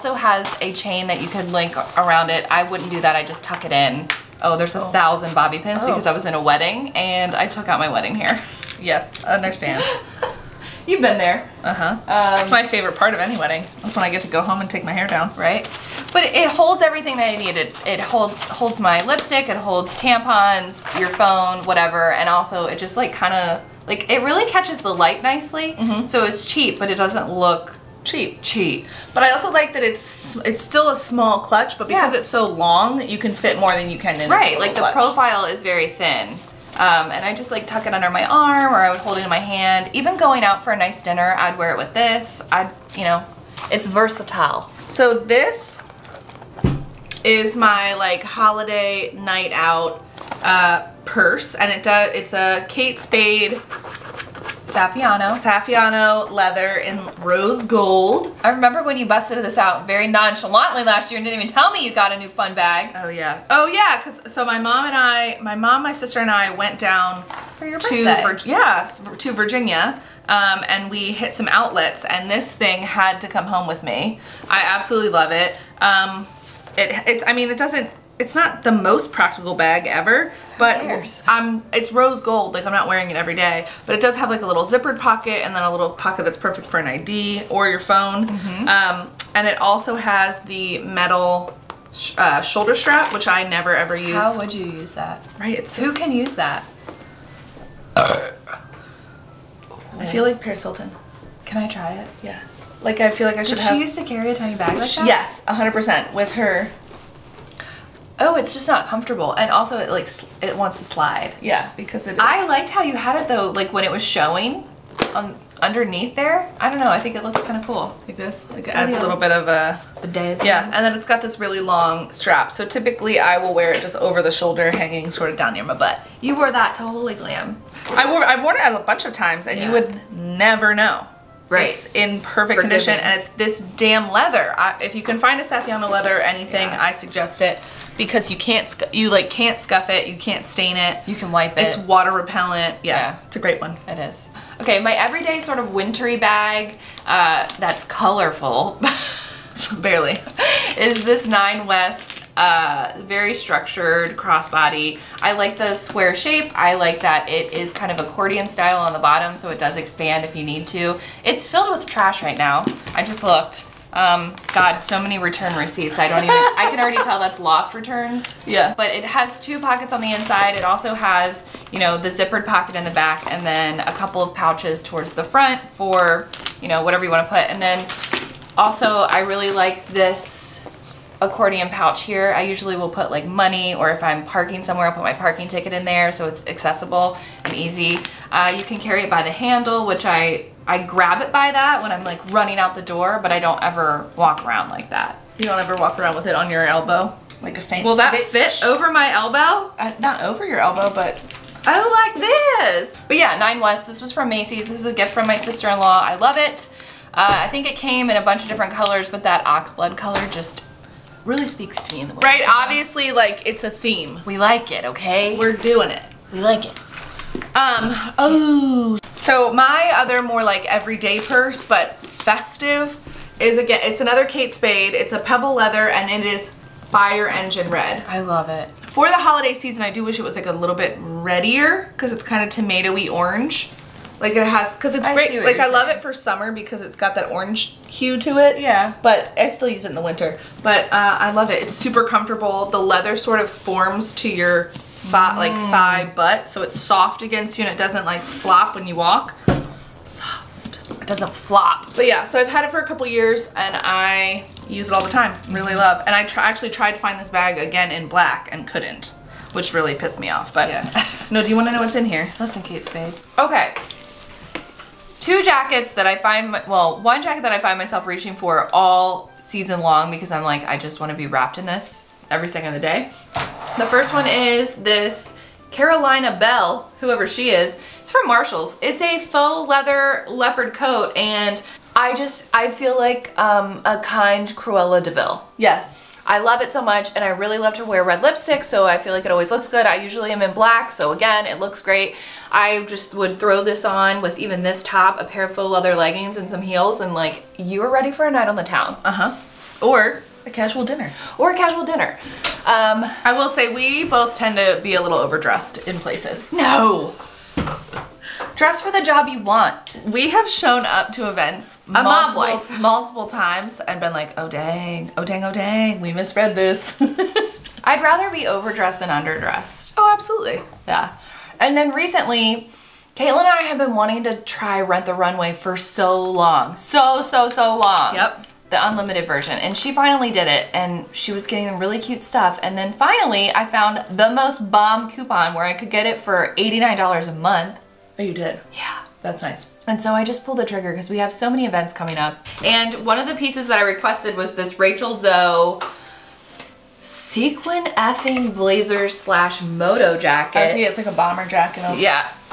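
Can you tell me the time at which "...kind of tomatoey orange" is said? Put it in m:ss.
3:52.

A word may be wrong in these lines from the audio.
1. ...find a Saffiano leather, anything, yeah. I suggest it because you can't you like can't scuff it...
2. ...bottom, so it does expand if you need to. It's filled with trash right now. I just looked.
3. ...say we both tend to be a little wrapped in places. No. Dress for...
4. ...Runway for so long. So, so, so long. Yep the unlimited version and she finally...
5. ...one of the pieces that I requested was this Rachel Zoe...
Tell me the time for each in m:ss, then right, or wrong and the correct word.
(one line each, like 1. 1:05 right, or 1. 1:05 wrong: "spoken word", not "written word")
1. 2:15 right
2. 2:38 right
3. 5:03 wrong: "overdressed", not "wrapped"
4. 5:25 right
5. 5:43 right.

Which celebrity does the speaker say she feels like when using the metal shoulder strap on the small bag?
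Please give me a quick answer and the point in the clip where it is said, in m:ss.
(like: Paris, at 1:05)
Paris Hilton, at 1:40.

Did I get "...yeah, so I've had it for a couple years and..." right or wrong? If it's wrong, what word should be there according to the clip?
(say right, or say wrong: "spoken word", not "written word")
right.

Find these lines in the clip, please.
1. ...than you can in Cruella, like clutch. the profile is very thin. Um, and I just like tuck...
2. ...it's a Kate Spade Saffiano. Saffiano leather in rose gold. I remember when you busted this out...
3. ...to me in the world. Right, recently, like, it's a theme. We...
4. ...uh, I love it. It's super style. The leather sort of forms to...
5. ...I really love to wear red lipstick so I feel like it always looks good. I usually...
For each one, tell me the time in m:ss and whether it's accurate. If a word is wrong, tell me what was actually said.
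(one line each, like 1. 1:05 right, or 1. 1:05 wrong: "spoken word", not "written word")
1. 0:33 wrong: "Right", not "Cruella"
2. 0:52 right
3. 3:31 wrong: "obviously", not "recently"
4. 4:00 wrong: "comfortable", not "style"
5. 4:47 right.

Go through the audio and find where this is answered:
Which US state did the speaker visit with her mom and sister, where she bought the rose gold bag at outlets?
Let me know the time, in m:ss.
1:09.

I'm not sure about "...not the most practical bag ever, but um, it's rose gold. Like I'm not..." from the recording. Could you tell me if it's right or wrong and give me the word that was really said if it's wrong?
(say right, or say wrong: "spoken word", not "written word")
right.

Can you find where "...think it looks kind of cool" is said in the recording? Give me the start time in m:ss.
1:57.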